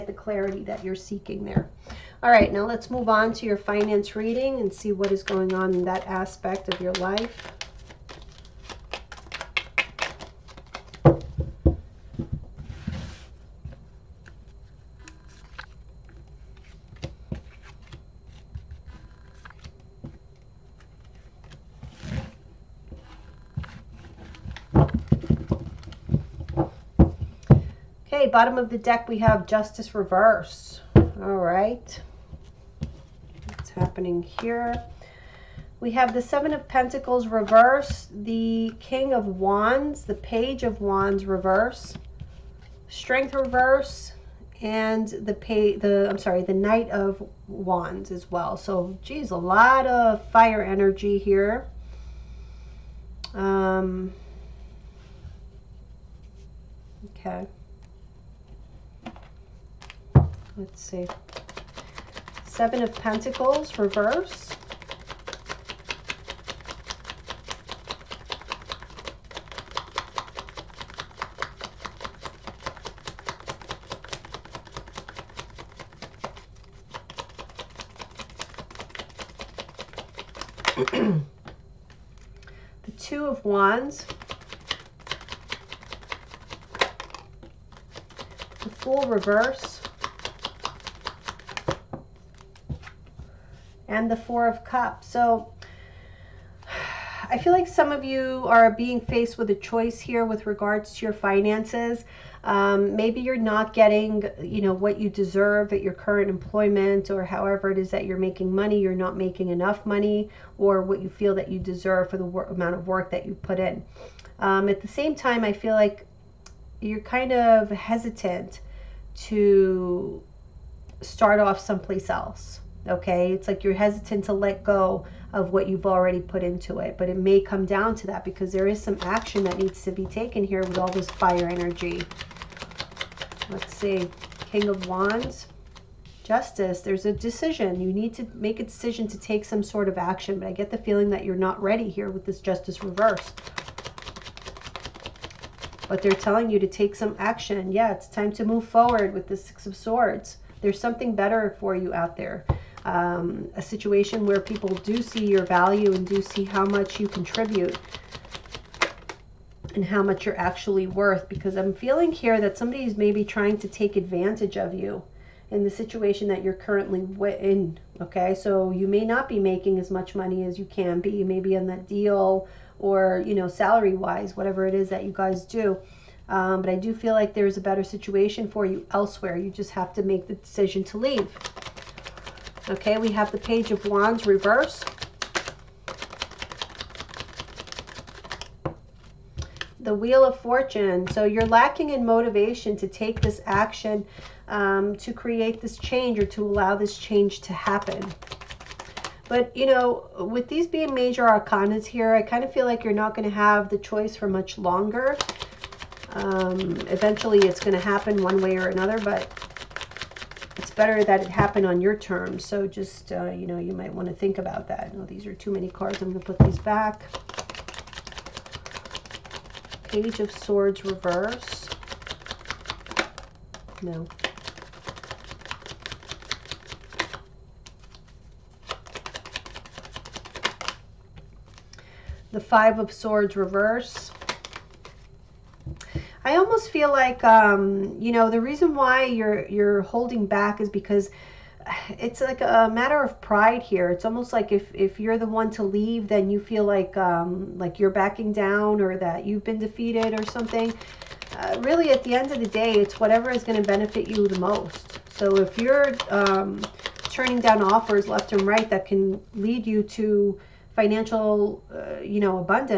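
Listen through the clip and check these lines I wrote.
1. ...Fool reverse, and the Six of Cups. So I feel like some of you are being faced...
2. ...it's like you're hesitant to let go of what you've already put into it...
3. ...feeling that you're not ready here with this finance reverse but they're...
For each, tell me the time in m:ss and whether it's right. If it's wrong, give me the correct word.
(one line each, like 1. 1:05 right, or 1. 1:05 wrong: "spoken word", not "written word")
1. 1:28 wrong: "Four", not "Six"
2. 2:03 right
3. 2:20 wrong: "justice", not "finance".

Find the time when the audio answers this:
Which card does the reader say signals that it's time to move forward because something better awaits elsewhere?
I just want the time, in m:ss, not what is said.
2:29.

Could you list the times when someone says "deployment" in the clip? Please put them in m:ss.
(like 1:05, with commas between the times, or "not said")
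not said.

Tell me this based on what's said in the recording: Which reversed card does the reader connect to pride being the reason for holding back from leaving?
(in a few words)
Five of Swords.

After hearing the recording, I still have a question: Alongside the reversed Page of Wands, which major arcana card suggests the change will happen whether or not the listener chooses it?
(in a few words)
Wheel of Fortune.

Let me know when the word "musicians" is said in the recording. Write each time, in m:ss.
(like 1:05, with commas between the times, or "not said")
not said.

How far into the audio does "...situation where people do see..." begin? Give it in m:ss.
2:33.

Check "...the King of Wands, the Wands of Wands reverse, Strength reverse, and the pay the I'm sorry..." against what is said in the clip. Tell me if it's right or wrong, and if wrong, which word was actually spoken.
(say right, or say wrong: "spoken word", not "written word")
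wrong: "Page", not "Wands".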